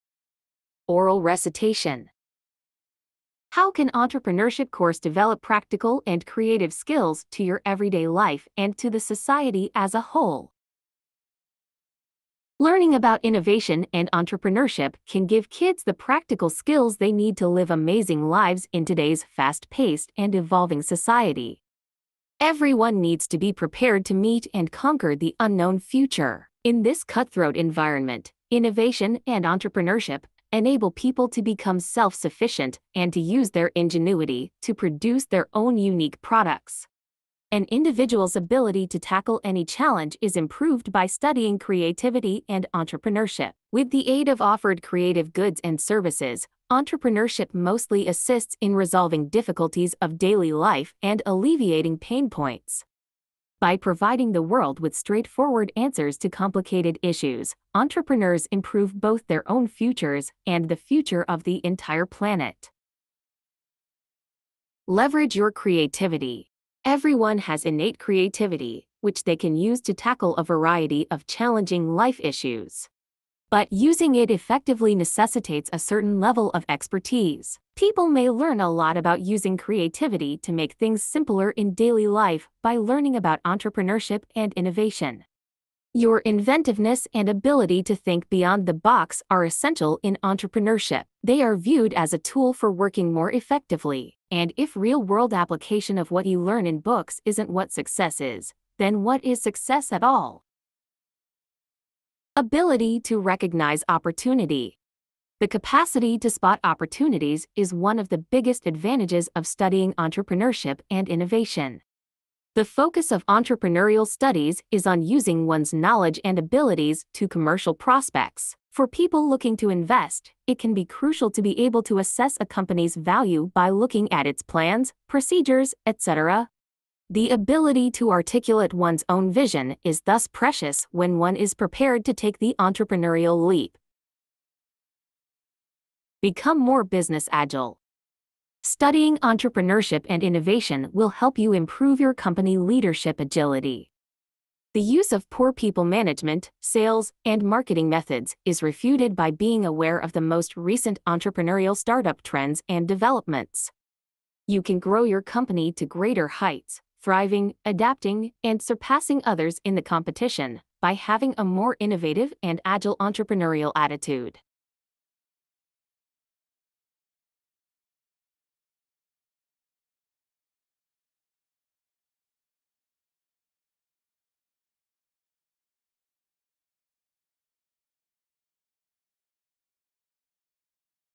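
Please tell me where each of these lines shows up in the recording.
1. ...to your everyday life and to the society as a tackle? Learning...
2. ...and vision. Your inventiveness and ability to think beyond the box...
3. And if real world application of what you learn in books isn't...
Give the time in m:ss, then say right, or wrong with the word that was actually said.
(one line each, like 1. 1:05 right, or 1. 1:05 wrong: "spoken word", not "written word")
1. 0:07 wrong: "whole", not "tackle"
2. 1:24 wrong: "innovation", not "vision"
3. 1:34 right.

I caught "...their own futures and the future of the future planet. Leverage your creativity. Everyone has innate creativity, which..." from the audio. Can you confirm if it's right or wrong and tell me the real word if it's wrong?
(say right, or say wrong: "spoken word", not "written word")
wrong: "entire", not "future".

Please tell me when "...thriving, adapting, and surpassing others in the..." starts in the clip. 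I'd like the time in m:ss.
2:37.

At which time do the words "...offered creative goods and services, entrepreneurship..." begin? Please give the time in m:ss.
0:44.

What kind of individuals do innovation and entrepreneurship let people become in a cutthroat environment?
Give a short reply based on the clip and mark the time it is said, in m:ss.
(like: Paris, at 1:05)
self sufficient, at 0:31.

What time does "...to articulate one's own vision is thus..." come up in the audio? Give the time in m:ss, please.
2:07.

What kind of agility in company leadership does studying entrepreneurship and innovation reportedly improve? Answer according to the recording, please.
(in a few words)
leadership agility.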